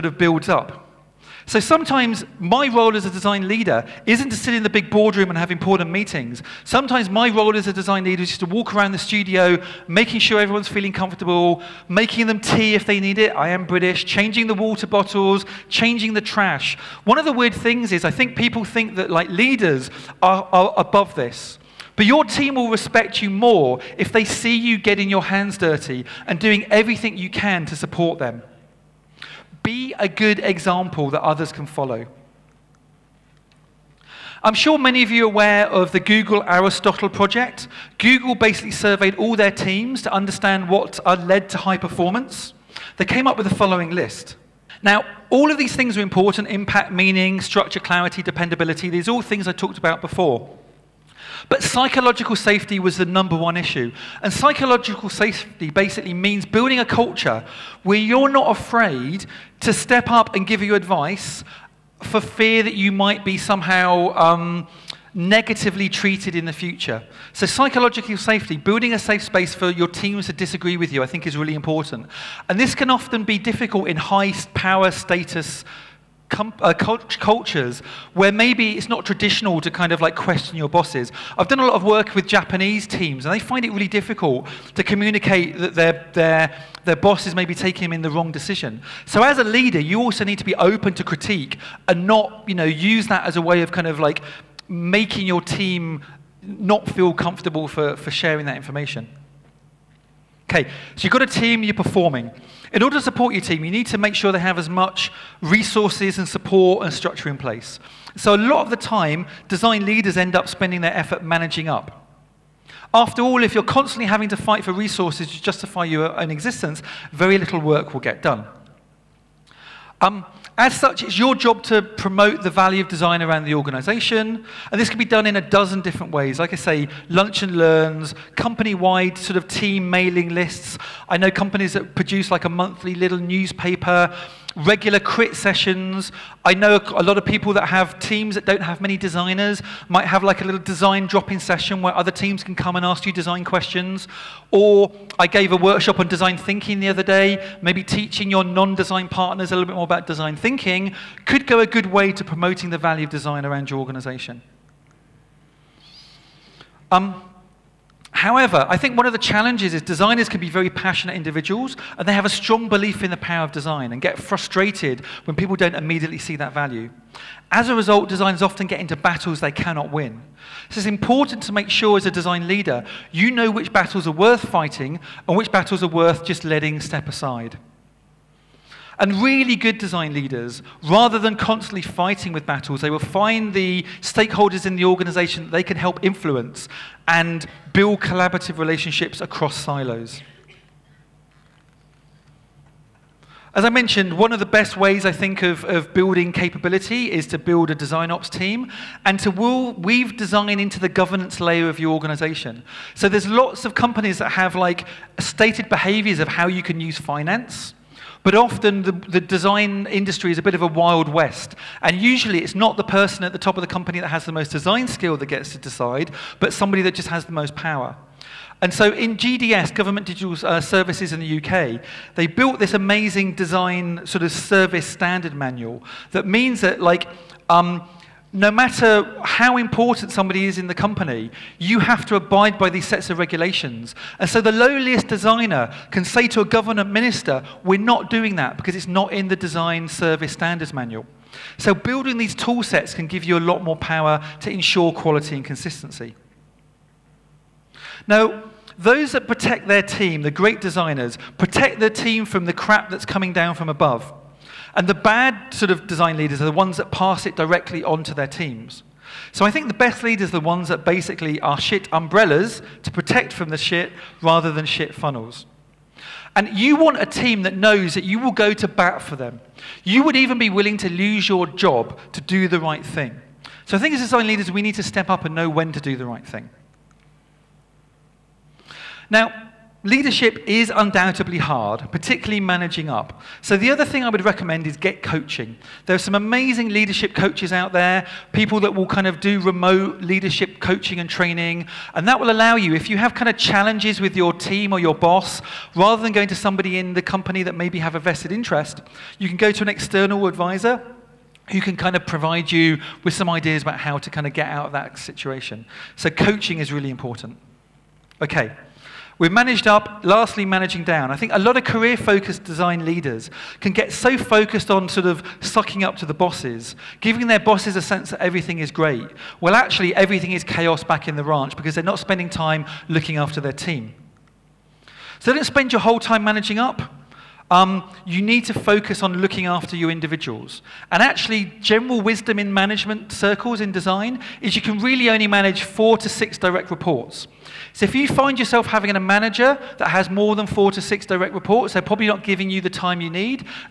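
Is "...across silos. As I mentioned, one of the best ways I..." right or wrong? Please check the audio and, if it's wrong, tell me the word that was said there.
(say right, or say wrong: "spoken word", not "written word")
right.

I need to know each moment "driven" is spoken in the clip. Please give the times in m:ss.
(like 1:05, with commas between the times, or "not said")
not said.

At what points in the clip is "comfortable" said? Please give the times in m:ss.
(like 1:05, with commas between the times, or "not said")
0:10, 1:37.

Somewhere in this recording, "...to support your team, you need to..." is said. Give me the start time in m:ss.
1:42.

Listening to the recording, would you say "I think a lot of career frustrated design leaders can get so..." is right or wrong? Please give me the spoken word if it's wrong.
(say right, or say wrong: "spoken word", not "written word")
wrong: "focused", not "frustrated".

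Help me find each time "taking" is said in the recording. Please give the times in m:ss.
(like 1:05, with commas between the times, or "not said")
1:27.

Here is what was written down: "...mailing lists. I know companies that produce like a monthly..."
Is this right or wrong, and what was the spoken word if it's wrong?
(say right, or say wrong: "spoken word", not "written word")
right.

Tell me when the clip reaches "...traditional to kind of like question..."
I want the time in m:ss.
1:19.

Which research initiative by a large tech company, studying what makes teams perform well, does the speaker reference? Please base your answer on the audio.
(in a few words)
Google Aristotle project.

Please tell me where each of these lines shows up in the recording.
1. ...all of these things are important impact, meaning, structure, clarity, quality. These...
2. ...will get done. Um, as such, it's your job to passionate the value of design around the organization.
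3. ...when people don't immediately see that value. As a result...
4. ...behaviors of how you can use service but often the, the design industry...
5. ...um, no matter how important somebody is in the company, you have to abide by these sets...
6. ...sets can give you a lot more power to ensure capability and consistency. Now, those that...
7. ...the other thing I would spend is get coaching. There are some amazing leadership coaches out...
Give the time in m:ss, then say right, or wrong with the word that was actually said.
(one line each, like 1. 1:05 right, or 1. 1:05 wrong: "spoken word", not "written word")
1. 0:45 wrong: "dependability", not "quality"
2. 1:57 wrong: "promote", not "passionate"
3. 2:45 right
4. 3:25 wrong: "finance", not "service"
5. 3:47 right
6. 4:02 wrong: "quality", not "capability"
7. 4:43 wrong: "recommend", not "spend".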